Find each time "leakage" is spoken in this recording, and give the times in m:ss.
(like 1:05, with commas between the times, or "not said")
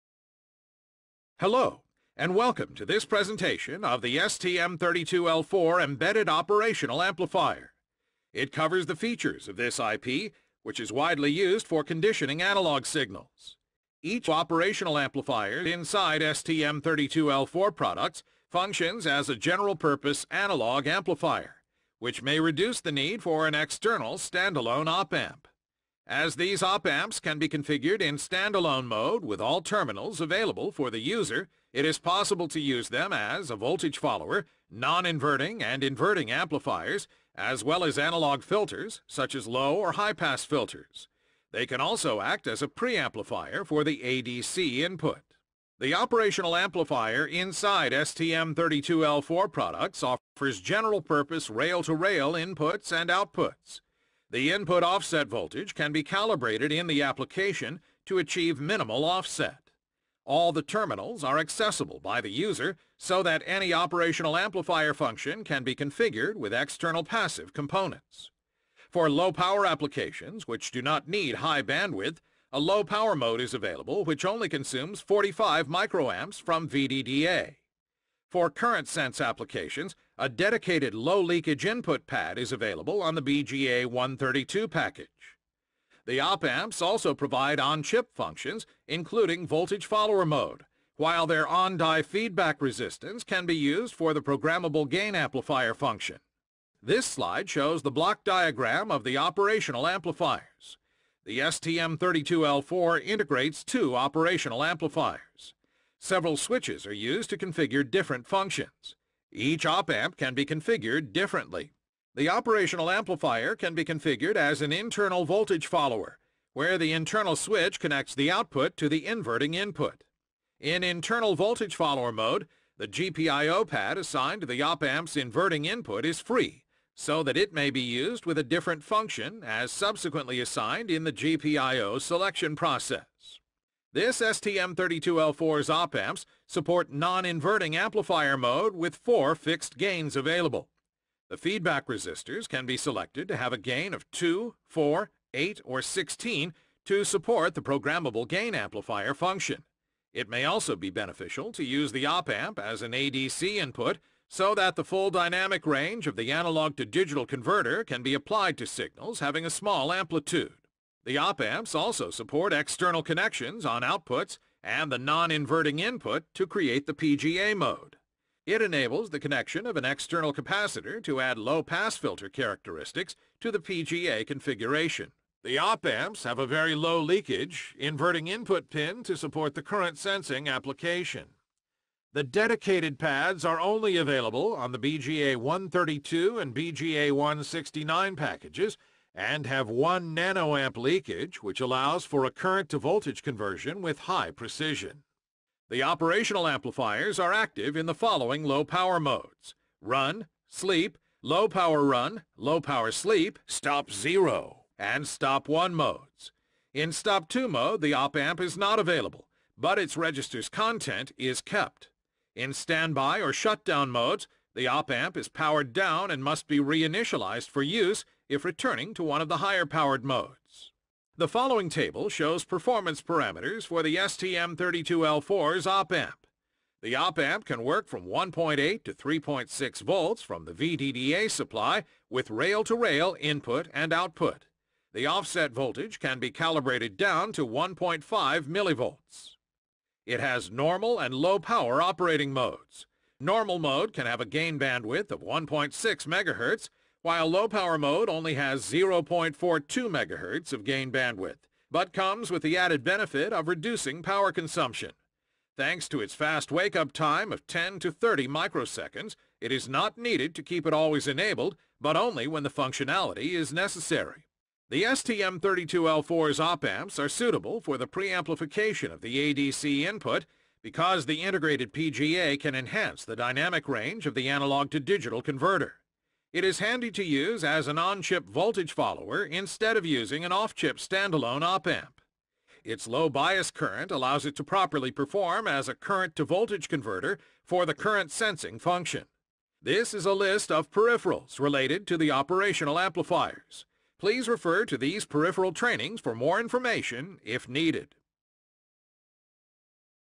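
1:20, 2:57, 3:10.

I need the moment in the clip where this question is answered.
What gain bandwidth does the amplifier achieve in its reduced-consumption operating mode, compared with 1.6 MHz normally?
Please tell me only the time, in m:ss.
4:08.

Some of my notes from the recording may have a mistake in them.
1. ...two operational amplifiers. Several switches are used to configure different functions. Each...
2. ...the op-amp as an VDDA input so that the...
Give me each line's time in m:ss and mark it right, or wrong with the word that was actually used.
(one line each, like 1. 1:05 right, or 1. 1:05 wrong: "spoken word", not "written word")
1. 1:43 right
2. 2:31 wrong: "ADC", not "VDDA".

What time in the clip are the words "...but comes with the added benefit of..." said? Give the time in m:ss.
4:11.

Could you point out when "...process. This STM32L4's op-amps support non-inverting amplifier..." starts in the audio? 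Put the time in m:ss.
2:12.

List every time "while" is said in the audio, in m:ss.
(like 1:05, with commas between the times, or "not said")
1:30, 4:07.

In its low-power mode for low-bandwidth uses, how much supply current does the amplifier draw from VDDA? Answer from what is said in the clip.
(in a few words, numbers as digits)
45 microamps.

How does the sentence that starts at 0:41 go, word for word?
They can also act as a preamplifier for the ADC input.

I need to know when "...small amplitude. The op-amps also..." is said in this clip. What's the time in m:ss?
2:39.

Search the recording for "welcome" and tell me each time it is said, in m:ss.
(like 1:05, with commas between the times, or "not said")
0:02.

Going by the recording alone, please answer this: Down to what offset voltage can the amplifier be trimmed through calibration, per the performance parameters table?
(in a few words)
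1.5 millivolts.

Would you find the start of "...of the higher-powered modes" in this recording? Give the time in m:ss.
3:39.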